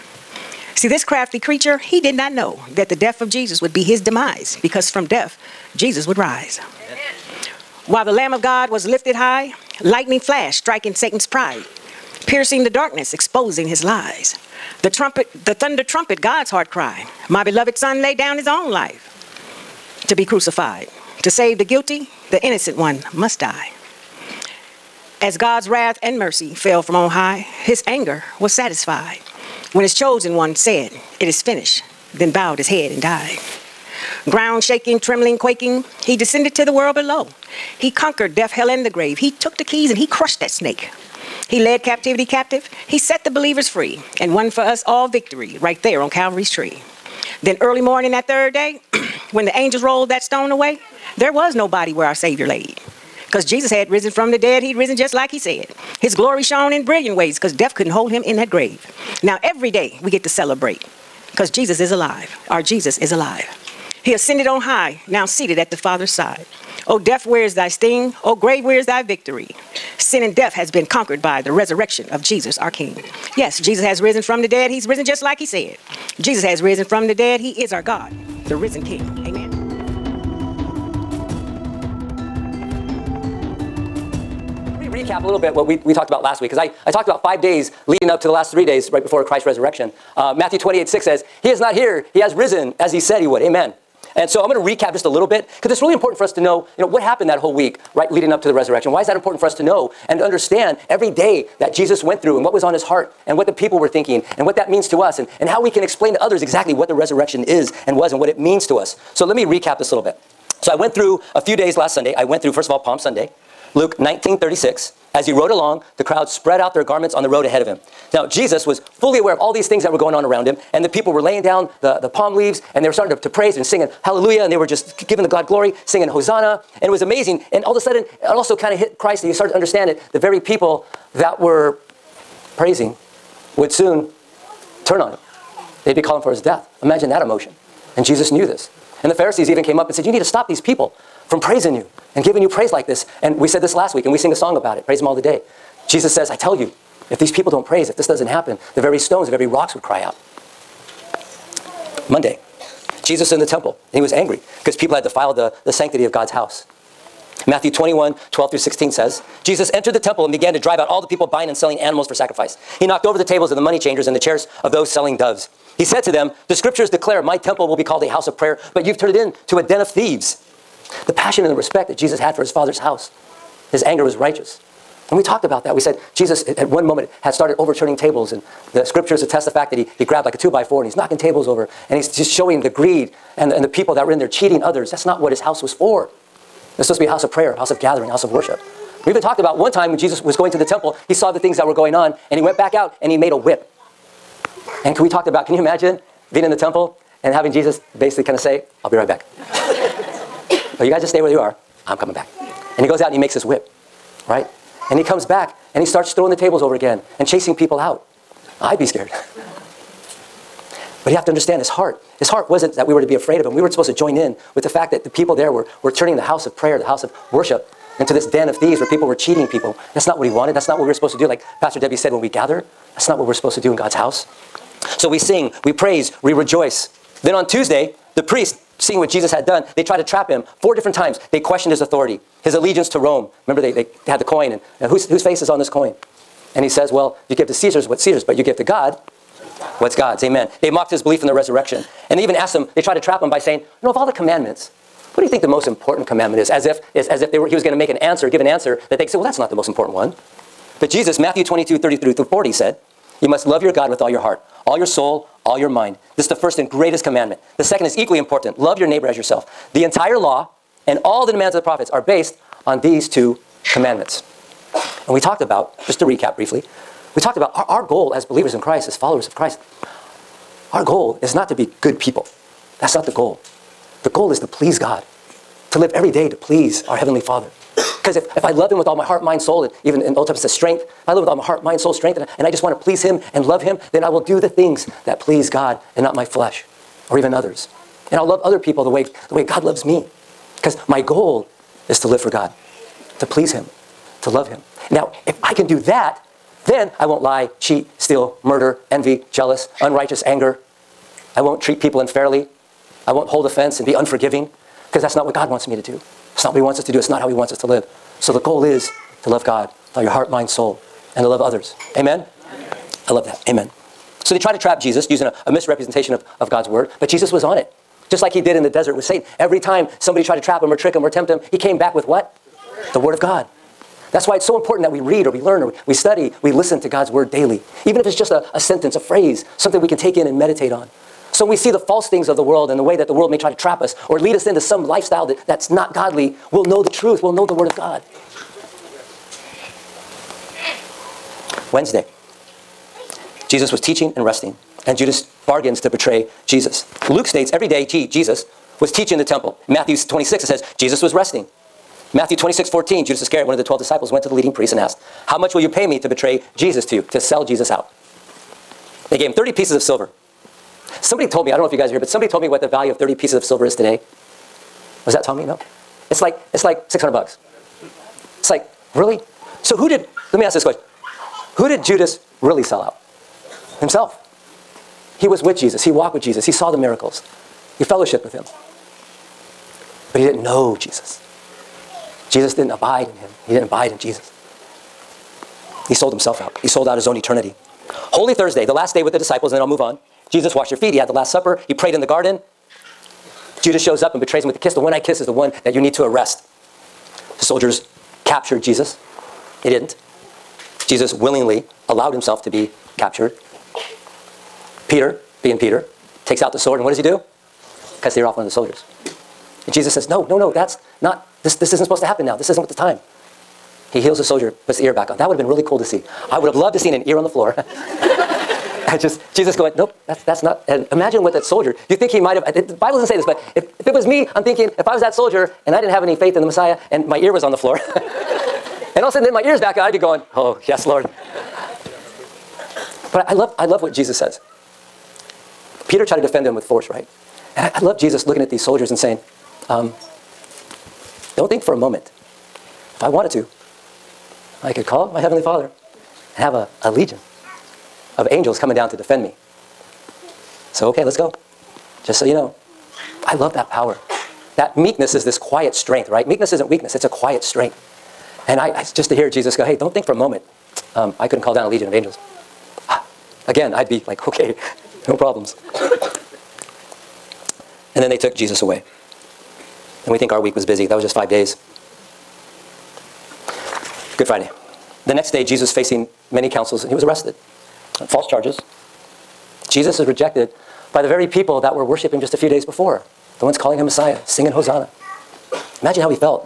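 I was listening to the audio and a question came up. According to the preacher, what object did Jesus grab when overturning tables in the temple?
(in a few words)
a two by four.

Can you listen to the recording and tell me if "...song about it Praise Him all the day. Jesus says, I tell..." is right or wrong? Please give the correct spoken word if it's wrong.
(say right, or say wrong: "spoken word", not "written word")
right.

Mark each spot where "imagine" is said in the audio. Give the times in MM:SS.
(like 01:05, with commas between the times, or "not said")
02:16, 03:15, 07:00, 08:05.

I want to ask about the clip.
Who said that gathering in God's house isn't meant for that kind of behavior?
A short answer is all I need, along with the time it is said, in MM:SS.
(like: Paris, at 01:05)
Pastor Debbie, at 03:41.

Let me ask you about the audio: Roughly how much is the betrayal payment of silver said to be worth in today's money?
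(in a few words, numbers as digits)
$600.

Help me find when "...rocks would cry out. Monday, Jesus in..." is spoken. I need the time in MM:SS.
02:29.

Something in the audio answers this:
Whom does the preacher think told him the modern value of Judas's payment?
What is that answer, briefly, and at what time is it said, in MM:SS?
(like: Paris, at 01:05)
Tommy, at 06:05.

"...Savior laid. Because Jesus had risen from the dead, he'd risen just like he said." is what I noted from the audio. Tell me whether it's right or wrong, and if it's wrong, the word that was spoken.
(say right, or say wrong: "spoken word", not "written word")
right.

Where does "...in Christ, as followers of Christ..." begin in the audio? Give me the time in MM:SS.
04:28.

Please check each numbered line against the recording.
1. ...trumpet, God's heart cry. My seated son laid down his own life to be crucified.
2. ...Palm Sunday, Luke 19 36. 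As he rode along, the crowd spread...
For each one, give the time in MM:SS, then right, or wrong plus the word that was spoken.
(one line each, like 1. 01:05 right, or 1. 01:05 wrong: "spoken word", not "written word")
1. 00:15 wrong: "beloved", not "seated"
2. 01:52 right.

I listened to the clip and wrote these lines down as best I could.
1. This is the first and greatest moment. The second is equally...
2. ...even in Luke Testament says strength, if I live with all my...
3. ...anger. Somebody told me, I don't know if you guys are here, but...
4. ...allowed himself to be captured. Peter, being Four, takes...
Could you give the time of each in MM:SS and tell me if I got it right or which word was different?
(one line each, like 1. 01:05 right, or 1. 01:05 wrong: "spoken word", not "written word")
1. 04:16 wrong: "commandment", not "moment"
2. 04:39 wrong: "Old", not "Luke"
3. 05:59 wrong: "silver", not "anger"
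4. 06:41 wrong: "Peter", not "Four".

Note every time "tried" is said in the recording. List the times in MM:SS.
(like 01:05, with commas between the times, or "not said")
04:02, 05:20, 07:16.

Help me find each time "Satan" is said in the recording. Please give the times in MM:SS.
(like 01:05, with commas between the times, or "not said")
00:10, 05:19.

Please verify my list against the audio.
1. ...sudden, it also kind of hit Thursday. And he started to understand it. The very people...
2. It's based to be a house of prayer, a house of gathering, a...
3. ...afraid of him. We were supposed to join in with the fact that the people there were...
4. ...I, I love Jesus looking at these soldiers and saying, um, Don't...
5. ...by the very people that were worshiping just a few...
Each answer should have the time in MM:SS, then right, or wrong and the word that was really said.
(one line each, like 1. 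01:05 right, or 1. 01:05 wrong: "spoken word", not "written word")
1. 02:07 wrong: "Christ", not "Thursday"
2. 03:06 wrong: "supposed", not "based"
3. 03:33 right
4. 07:17 right
5. 08:00 right.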